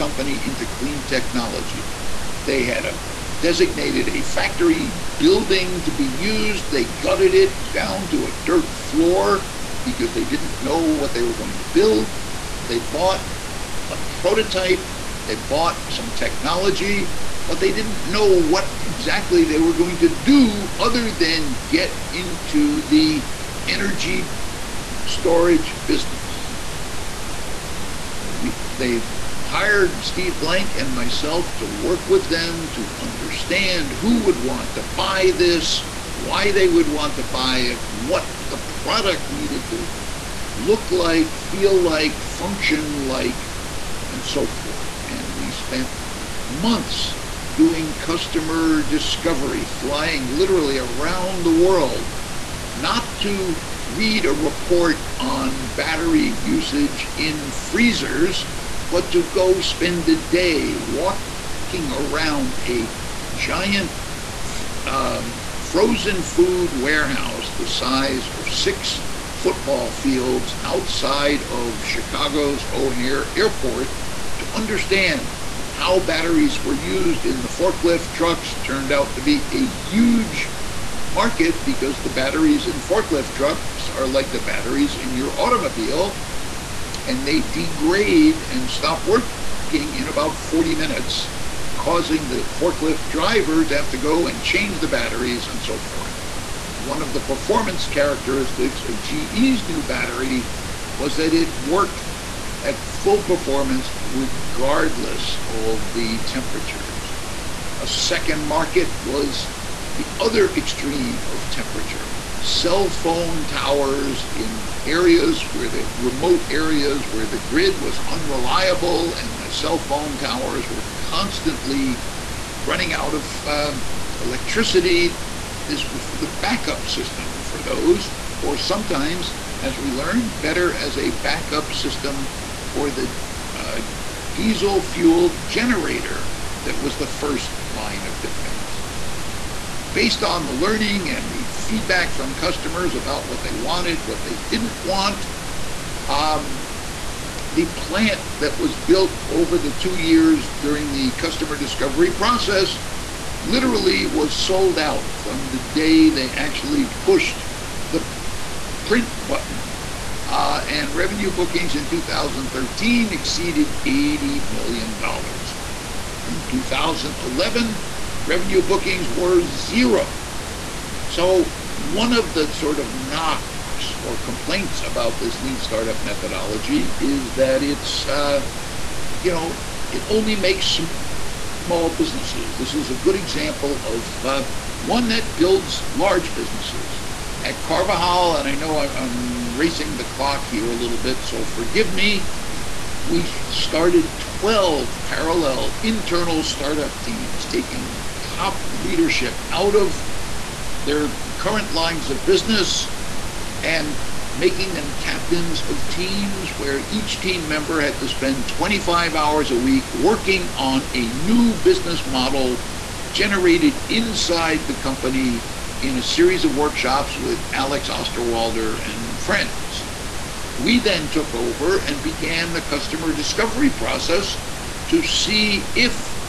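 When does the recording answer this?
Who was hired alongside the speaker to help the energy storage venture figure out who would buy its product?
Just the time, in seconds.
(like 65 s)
30 s.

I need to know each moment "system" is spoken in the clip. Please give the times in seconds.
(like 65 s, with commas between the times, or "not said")
126 s, 131 s.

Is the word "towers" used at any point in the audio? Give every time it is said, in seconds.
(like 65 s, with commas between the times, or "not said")
113 s, 120 s.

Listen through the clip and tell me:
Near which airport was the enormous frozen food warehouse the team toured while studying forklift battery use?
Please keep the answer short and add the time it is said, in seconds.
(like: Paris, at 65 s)
O'Hare Airport, at 72 s.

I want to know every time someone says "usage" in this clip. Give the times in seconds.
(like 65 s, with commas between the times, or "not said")
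56 s.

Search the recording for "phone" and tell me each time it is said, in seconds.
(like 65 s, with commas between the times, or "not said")
112 s, 119 s.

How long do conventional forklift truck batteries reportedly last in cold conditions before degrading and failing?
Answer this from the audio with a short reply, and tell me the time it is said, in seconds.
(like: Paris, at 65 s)
40 minutes, at 90 s.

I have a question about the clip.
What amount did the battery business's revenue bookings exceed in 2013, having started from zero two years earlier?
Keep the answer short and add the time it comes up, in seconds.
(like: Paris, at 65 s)
$80 million, at 163 s.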